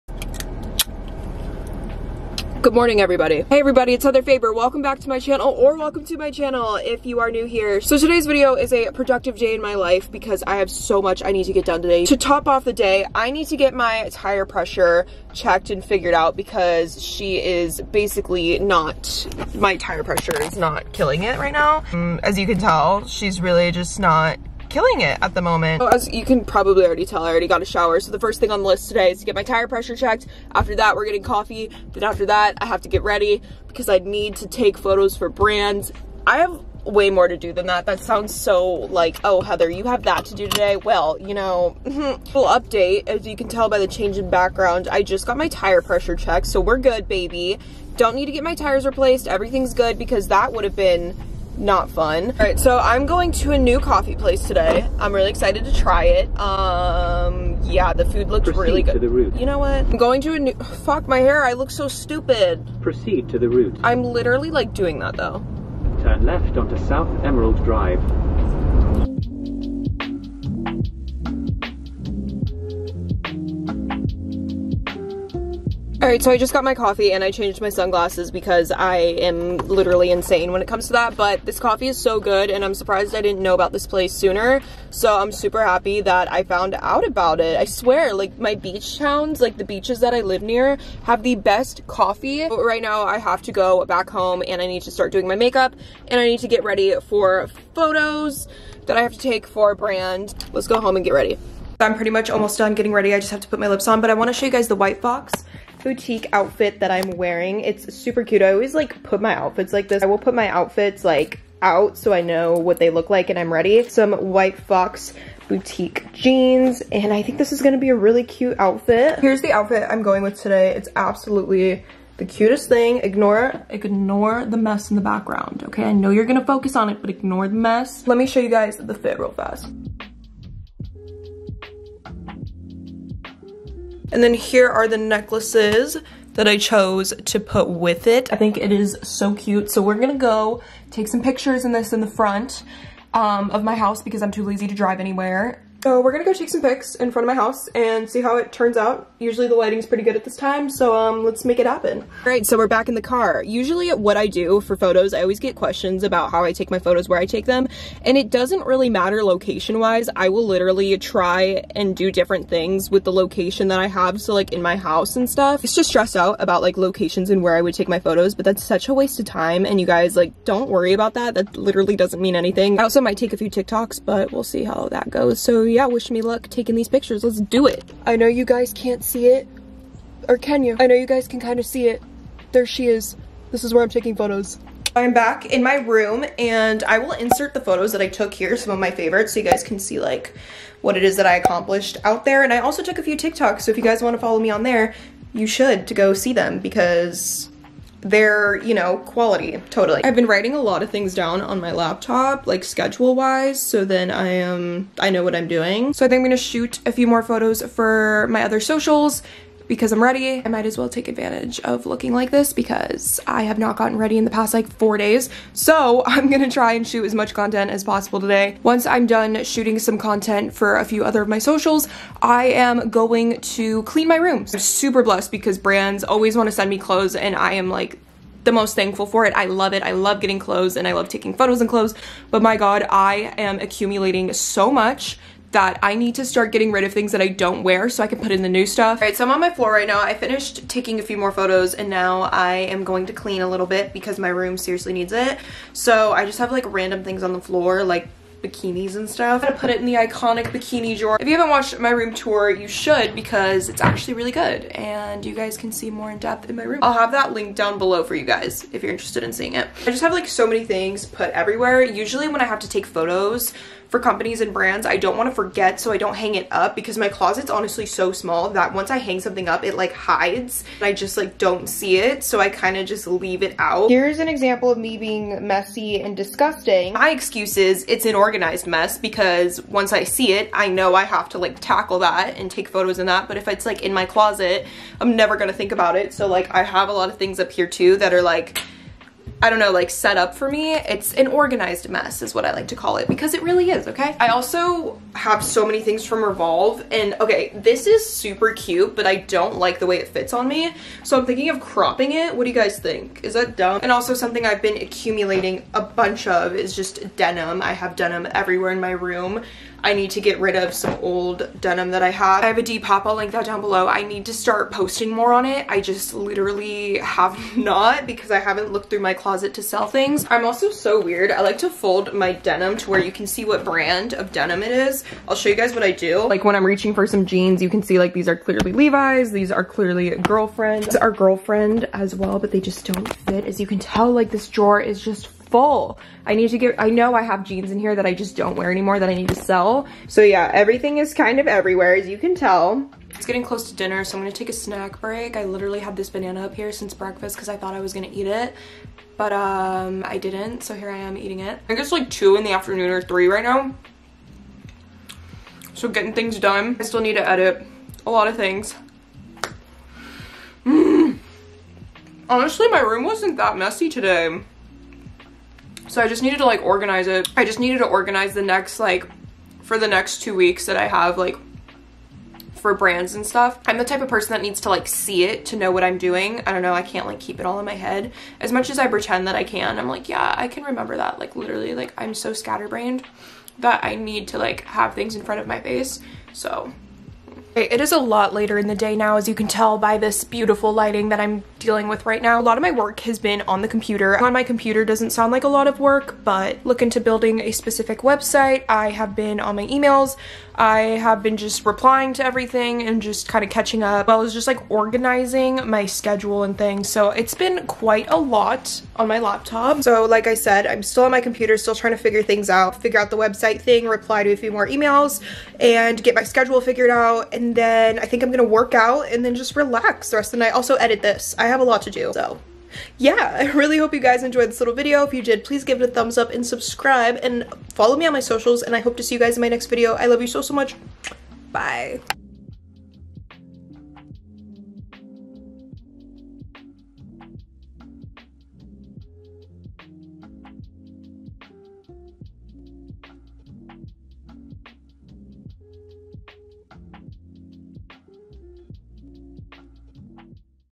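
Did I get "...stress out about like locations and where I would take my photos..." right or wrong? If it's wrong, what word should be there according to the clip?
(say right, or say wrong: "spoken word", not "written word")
right.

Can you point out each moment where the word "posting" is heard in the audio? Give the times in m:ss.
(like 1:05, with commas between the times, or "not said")
5:14.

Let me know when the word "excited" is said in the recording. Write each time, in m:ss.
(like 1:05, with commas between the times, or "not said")
0:55.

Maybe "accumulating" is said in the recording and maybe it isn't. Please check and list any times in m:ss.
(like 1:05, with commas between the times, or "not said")
3:53, 5:04.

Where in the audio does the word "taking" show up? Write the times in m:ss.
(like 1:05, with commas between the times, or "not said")
2:56, 3:03, 3:51, 4:00.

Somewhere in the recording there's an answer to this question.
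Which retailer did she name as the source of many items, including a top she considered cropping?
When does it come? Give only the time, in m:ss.
4:56.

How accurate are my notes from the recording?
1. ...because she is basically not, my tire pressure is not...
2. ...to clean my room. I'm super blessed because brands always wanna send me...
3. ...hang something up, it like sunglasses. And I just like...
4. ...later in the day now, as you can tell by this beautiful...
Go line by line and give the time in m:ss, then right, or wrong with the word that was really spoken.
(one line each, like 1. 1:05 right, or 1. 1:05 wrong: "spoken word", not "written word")
1. 0:16 right
2. 3:43 right
3. 4:28 wrong: "hides", not "sunglasses"
4. 6:28 right.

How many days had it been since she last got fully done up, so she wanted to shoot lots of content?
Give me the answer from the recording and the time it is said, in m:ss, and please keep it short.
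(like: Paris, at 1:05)
4, at 3:34.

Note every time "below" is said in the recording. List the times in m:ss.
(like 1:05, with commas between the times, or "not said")
4:17, 5:13.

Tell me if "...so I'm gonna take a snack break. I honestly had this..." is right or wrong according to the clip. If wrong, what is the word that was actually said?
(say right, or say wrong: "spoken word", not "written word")
wrong: "literally", not "honestly".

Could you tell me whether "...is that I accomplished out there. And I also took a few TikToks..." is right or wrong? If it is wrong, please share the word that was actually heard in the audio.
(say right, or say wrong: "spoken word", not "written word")
right.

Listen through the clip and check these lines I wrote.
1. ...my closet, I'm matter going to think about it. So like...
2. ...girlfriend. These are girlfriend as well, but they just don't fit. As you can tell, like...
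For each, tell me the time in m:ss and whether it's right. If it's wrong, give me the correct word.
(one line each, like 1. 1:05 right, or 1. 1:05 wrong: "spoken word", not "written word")
1. 4:43 wrong: "never", not "matter"
2. 5:30 right.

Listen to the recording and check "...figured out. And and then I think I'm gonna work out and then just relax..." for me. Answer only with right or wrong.
right.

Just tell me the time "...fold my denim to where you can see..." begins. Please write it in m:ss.
5:21.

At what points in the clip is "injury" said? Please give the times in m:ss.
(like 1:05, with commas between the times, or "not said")
not said.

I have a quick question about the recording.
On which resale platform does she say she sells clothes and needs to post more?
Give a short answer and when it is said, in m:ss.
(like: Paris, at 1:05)
Depop, at 5:12.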